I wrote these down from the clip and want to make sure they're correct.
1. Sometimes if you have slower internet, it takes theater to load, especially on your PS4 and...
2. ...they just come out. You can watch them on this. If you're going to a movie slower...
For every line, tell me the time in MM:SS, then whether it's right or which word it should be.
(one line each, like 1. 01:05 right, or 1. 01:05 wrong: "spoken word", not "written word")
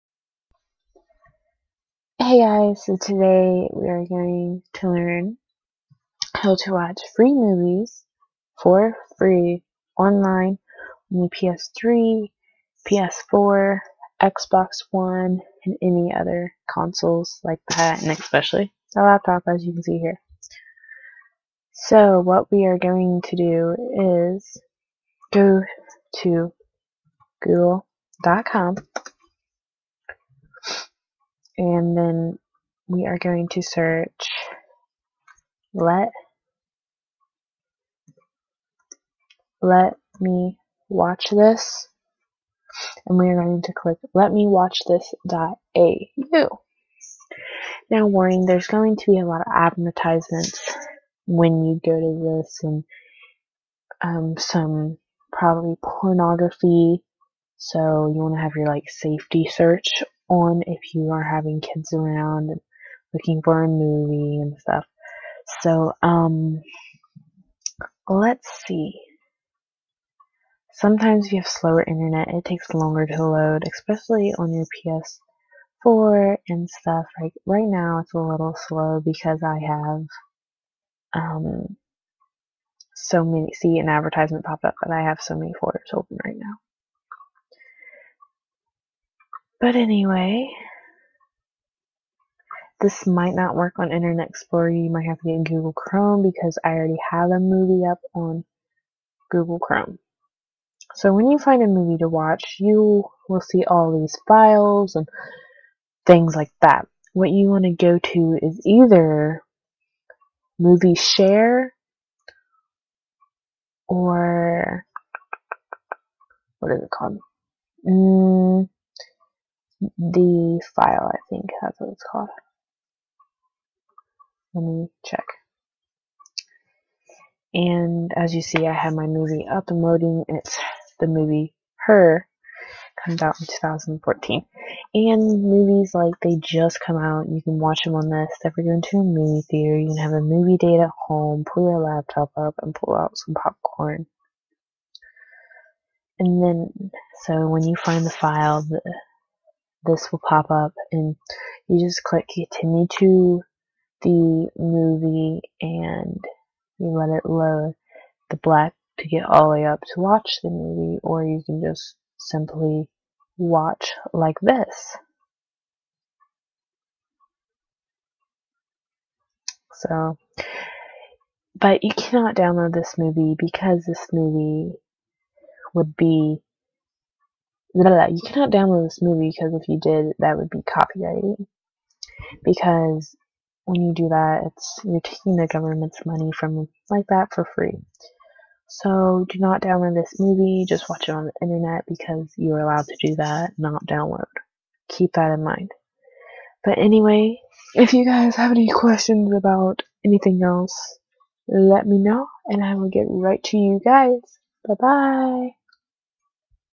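1. 01:10 wrong: "longer", not "theater"
2. 02:16 wrong: "theater", not "slower".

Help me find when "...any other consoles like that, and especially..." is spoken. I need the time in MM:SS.
00:15.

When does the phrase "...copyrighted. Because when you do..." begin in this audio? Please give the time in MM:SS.
03:00.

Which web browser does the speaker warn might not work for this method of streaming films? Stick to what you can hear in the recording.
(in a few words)
Internet Explorer.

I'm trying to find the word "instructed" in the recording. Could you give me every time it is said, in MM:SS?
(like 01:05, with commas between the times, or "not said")
not said.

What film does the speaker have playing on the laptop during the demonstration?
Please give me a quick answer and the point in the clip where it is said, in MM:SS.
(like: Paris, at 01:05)
Her, at 02:11.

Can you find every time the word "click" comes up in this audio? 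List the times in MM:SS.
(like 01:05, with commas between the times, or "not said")
00:43, 02:32.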